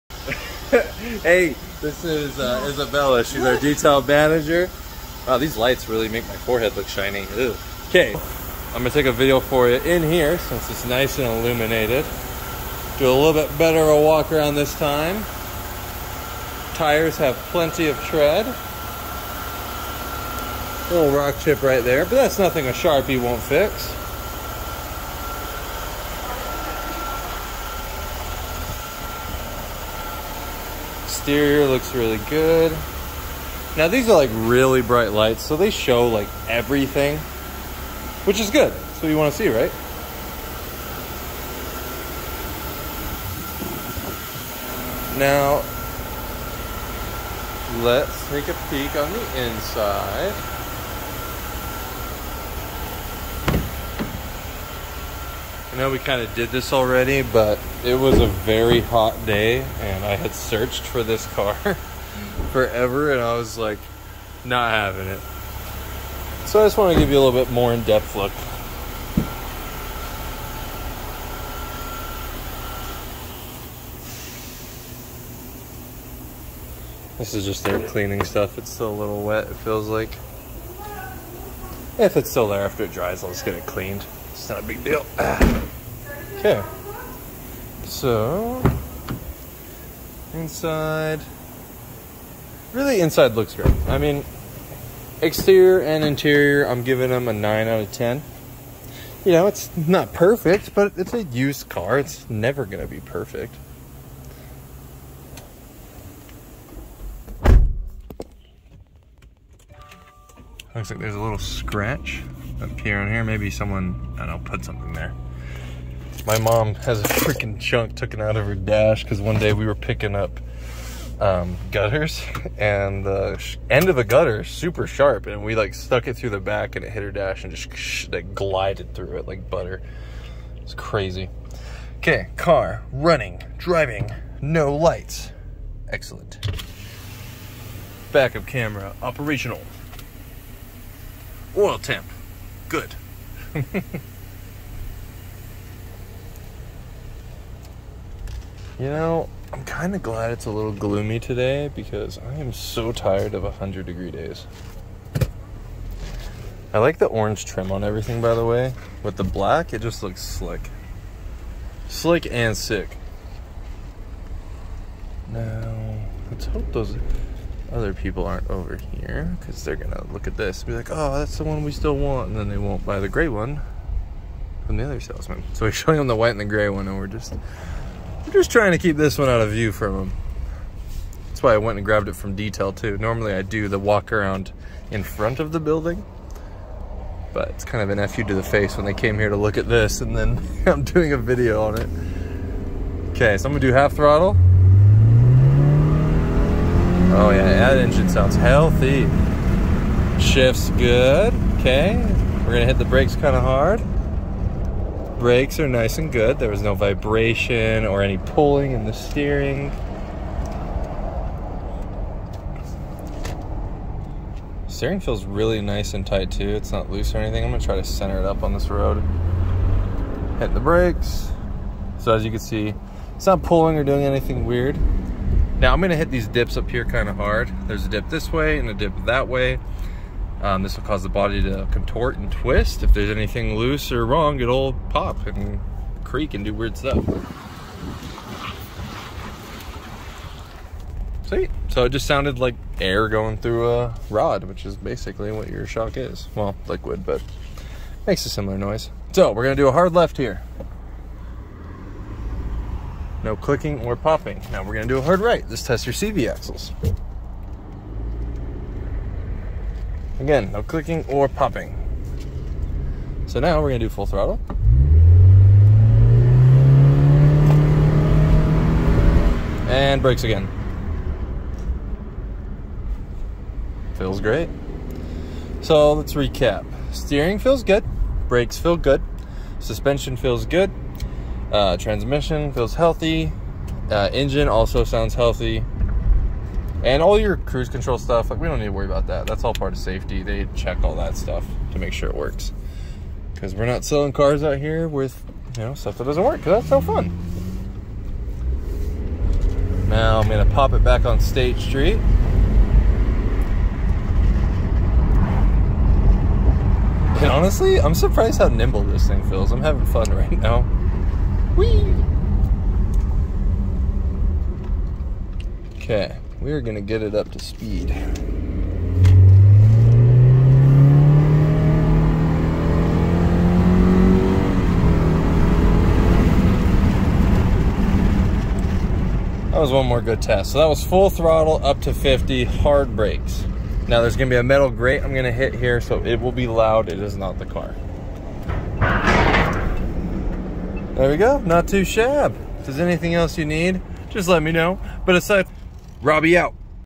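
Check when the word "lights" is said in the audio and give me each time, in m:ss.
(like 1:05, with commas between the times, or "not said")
0:05, 0:35, 2:14.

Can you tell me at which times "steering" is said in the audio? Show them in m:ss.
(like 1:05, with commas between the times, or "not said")
3:28, 3:34, 4:36.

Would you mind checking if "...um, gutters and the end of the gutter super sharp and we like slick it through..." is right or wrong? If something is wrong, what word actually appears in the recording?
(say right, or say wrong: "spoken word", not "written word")
wrong: "stuck", not "slick".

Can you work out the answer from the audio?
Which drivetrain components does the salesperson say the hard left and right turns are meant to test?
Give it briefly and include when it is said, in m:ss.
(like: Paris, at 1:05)
CV axles, at 4:15.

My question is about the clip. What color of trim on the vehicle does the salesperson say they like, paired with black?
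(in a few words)
Orange.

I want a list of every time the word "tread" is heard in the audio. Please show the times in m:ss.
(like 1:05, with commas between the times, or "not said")
0:18.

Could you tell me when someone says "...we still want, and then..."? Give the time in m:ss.
2:51.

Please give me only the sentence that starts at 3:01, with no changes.
That's why I went and grabbed it from detail too.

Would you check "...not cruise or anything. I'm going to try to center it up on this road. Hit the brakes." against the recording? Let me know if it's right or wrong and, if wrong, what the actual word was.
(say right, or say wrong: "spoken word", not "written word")
wrong: "loose", not "cruise".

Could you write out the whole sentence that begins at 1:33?
I mean, exterior and interior, I'm giving them a 9 out of 10.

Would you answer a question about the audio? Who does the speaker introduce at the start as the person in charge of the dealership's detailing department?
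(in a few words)
Isabella.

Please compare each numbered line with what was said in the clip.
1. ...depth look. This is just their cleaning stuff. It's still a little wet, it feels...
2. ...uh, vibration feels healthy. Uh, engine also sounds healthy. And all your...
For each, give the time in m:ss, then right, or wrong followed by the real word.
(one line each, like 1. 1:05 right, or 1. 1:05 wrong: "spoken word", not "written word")
1. 1:07 right
2. 4:41 wrong: "transmission", not "vibration".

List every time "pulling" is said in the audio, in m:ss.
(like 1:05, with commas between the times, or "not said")
3:28, 3:43.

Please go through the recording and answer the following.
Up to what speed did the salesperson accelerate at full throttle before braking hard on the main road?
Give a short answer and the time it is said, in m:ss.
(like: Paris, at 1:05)
50, at 5:31.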